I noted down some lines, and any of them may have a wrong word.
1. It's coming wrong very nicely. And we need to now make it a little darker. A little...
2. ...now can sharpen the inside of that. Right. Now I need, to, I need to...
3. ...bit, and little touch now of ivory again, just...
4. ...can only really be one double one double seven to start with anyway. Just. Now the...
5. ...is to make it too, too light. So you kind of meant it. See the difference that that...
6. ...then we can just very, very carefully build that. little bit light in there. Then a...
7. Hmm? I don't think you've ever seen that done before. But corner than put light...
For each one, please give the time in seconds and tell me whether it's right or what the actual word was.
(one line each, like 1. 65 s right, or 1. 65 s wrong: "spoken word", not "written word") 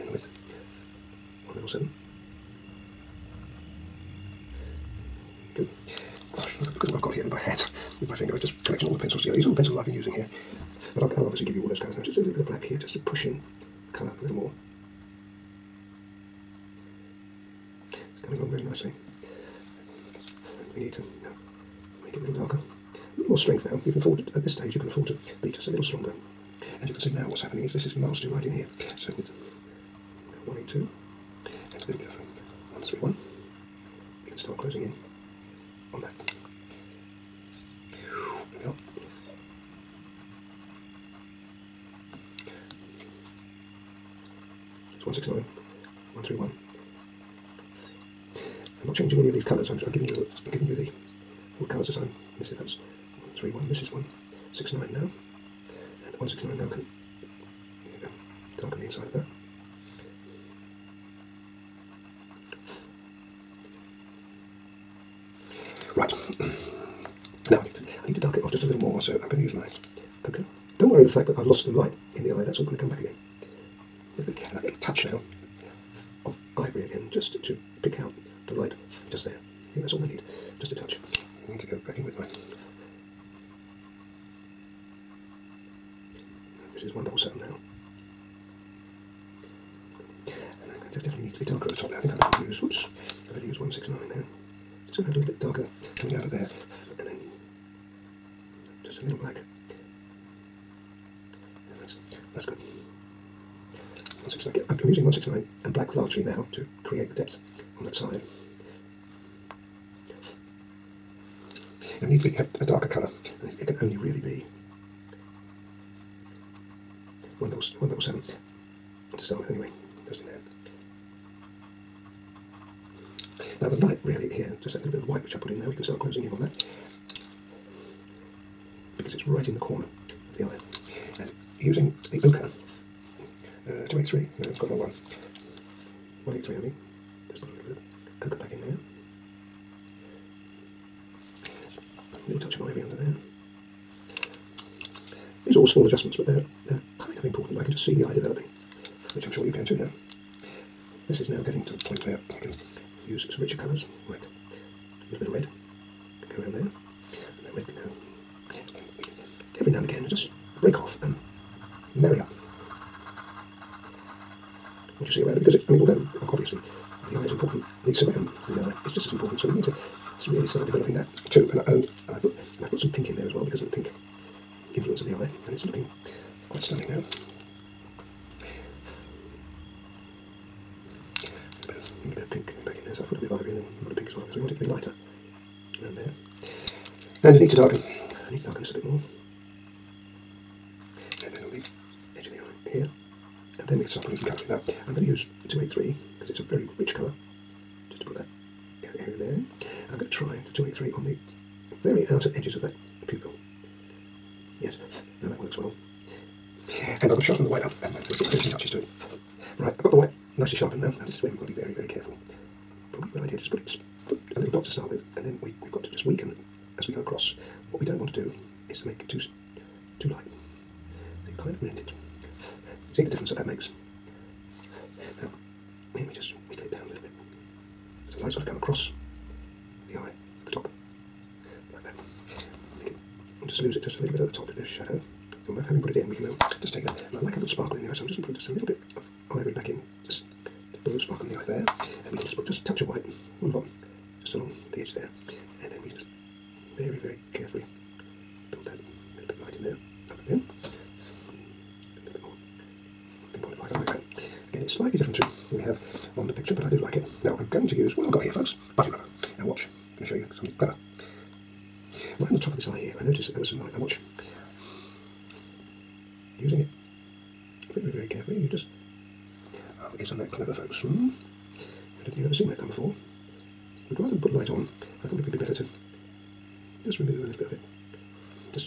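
1. 18 s wrong: "along", not "wrong"
2. 56 s wrong: "darken", not "sharpen"
3. 74 s right
4. 113 s right
5. 218 s right
6. 245 s right
7. 270 s wrong: "rather", not "corner".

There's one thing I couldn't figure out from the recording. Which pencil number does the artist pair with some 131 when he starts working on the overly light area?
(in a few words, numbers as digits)
182.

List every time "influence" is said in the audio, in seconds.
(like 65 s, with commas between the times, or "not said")
174 s.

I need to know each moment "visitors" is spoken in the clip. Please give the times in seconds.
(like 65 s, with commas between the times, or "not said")
not said.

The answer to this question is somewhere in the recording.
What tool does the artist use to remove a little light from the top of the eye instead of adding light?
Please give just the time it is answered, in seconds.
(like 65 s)
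258 s.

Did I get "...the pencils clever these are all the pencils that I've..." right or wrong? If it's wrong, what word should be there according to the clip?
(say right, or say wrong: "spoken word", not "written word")
wrong: "together", not "clever".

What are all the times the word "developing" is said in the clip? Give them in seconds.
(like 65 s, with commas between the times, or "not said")
148 s, 170 s.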